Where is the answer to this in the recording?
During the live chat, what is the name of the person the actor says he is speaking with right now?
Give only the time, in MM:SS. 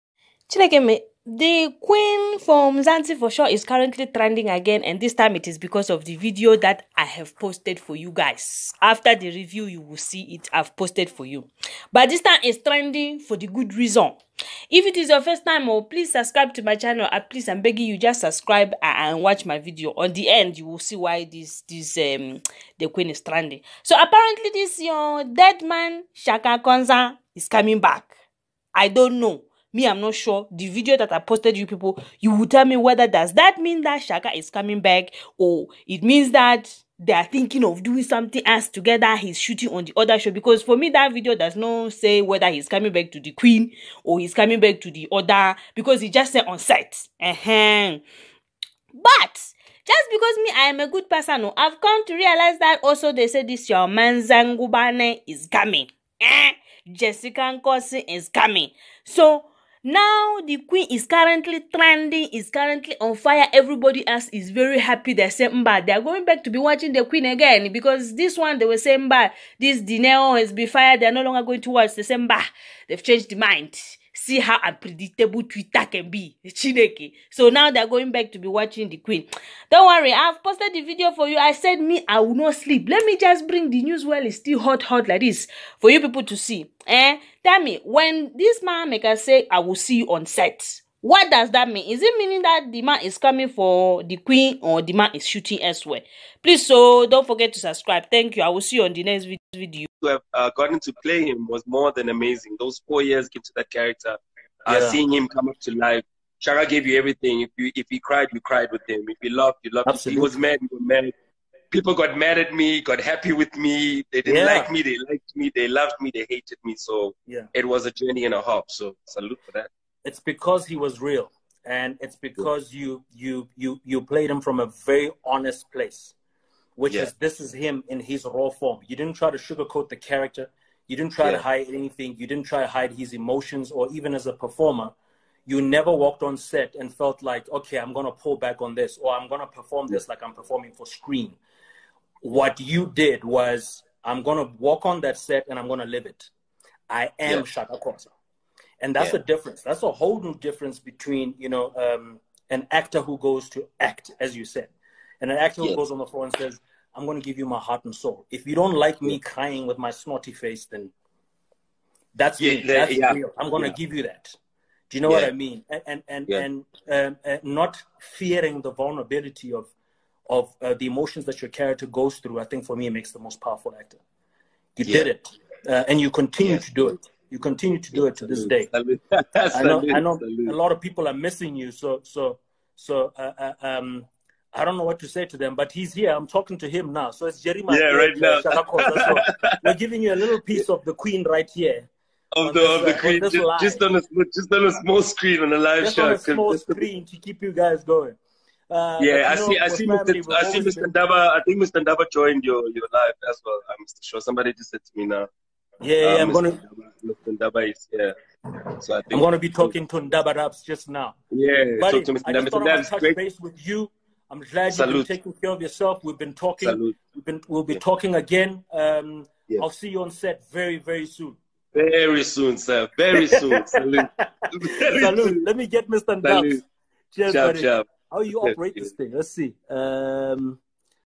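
03:07.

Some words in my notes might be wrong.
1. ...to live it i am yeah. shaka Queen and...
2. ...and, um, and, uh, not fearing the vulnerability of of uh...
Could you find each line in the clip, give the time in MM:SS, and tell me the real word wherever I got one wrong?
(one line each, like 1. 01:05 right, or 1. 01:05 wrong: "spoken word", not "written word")
1. 02:25 wrong: "Khoza", not "Queen"
2. 02:46 right.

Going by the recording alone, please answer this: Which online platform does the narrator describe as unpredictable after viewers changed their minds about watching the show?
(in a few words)
Twitter.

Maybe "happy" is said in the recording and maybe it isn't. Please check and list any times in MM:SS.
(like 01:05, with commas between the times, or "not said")
01:04, 01:52.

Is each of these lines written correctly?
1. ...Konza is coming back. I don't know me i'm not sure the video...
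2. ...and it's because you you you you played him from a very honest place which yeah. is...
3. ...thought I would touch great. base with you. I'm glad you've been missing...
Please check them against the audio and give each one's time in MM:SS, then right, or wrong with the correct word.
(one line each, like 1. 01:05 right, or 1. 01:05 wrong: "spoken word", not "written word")
1. 00:26 right
2. 02:01 right
3. 03:32 wrong: "taking", not "missing".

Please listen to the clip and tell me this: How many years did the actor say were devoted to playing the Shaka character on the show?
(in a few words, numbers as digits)
4.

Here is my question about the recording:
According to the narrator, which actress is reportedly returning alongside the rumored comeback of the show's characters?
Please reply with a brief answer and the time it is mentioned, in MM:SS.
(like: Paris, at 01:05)
Jessica Nkosi, at 00:56.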